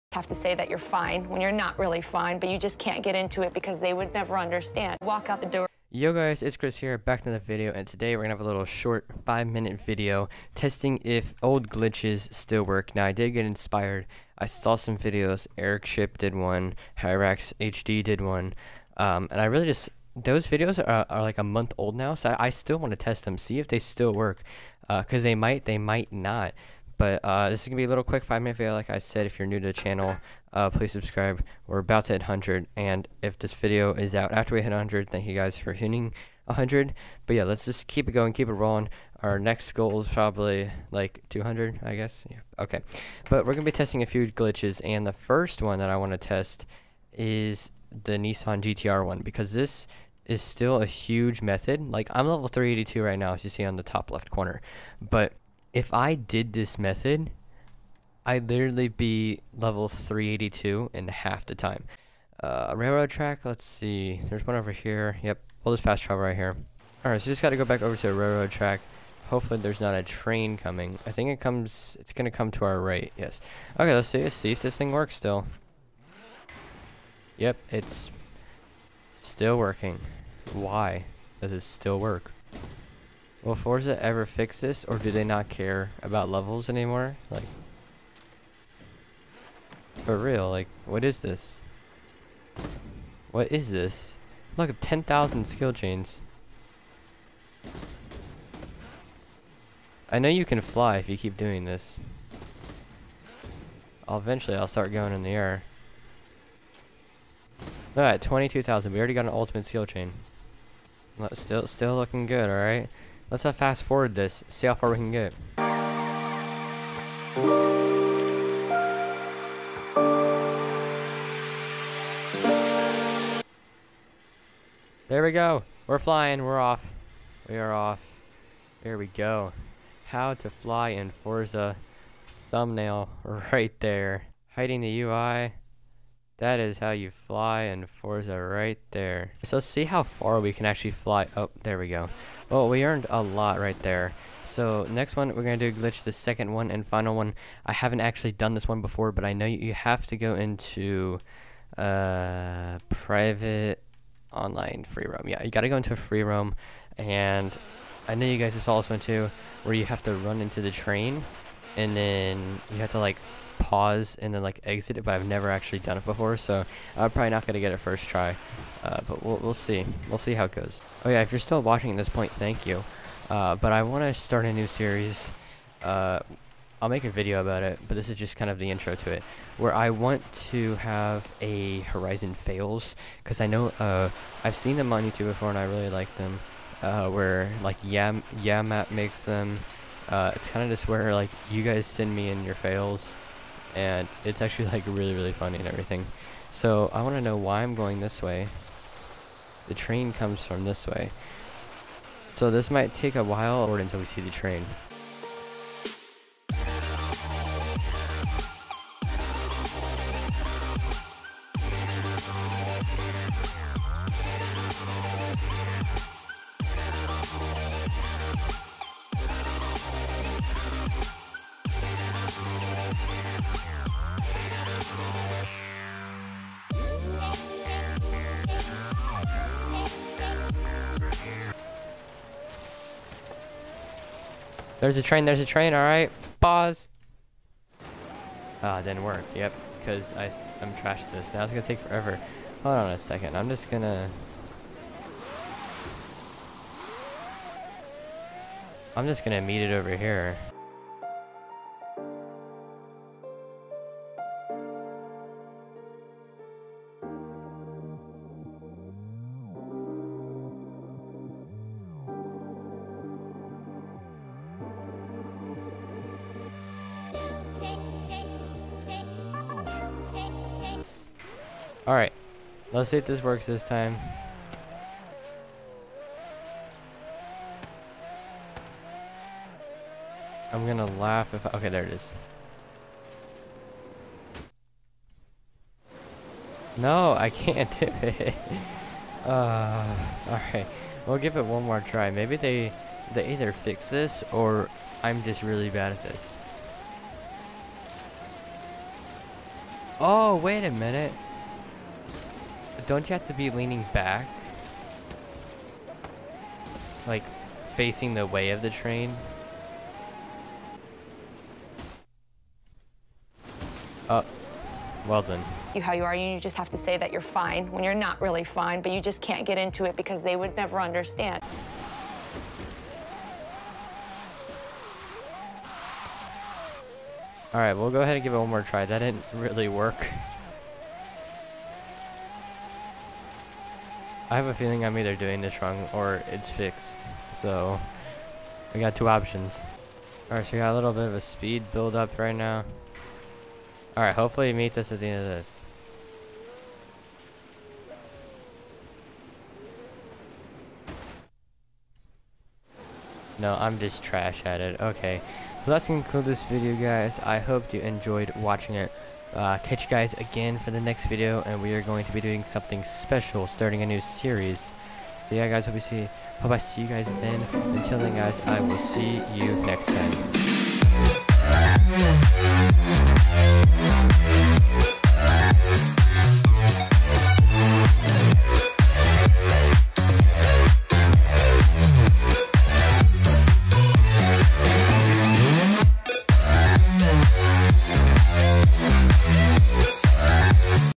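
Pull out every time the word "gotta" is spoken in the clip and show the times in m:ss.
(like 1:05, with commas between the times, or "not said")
1:07.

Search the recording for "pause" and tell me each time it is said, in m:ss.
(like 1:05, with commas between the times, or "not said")
2:43, 3:56.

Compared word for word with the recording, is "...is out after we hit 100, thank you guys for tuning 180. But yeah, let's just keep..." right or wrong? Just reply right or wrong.
wrong.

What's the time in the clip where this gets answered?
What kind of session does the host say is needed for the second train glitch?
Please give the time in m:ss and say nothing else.
2:32.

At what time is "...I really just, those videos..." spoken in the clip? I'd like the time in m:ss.
0:19.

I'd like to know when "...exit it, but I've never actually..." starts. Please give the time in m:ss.
2:44.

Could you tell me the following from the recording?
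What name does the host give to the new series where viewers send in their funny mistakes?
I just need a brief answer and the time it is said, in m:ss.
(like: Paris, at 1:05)
Horizon Fails, at 3:01.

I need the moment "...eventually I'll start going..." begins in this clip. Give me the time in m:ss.
1:44.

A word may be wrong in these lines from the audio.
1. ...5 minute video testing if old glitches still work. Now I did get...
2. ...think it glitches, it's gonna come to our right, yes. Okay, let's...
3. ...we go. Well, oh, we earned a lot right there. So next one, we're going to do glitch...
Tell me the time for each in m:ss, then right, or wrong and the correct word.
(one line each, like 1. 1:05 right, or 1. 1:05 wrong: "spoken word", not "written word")
1. 0:09 right
2. 1:11 wrong: "comes", not "glitches"
3. 2:21 right.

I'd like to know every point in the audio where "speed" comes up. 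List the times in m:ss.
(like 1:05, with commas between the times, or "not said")
5:41.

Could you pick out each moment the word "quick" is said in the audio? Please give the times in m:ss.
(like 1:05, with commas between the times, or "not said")
0:28.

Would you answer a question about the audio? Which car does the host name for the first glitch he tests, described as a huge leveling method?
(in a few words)
Nissan GTR.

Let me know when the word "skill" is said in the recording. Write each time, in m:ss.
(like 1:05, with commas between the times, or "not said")
1:35, 1:49.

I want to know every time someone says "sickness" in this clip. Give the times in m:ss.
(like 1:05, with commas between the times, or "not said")
not said.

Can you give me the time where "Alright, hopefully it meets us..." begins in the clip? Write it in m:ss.
5:43.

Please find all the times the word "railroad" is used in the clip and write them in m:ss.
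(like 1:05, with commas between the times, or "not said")
1:02, 1:08.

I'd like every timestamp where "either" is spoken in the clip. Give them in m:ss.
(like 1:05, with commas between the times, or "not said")
4:53, 5:34.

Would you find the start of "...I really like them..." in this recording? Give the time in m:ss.
3:05.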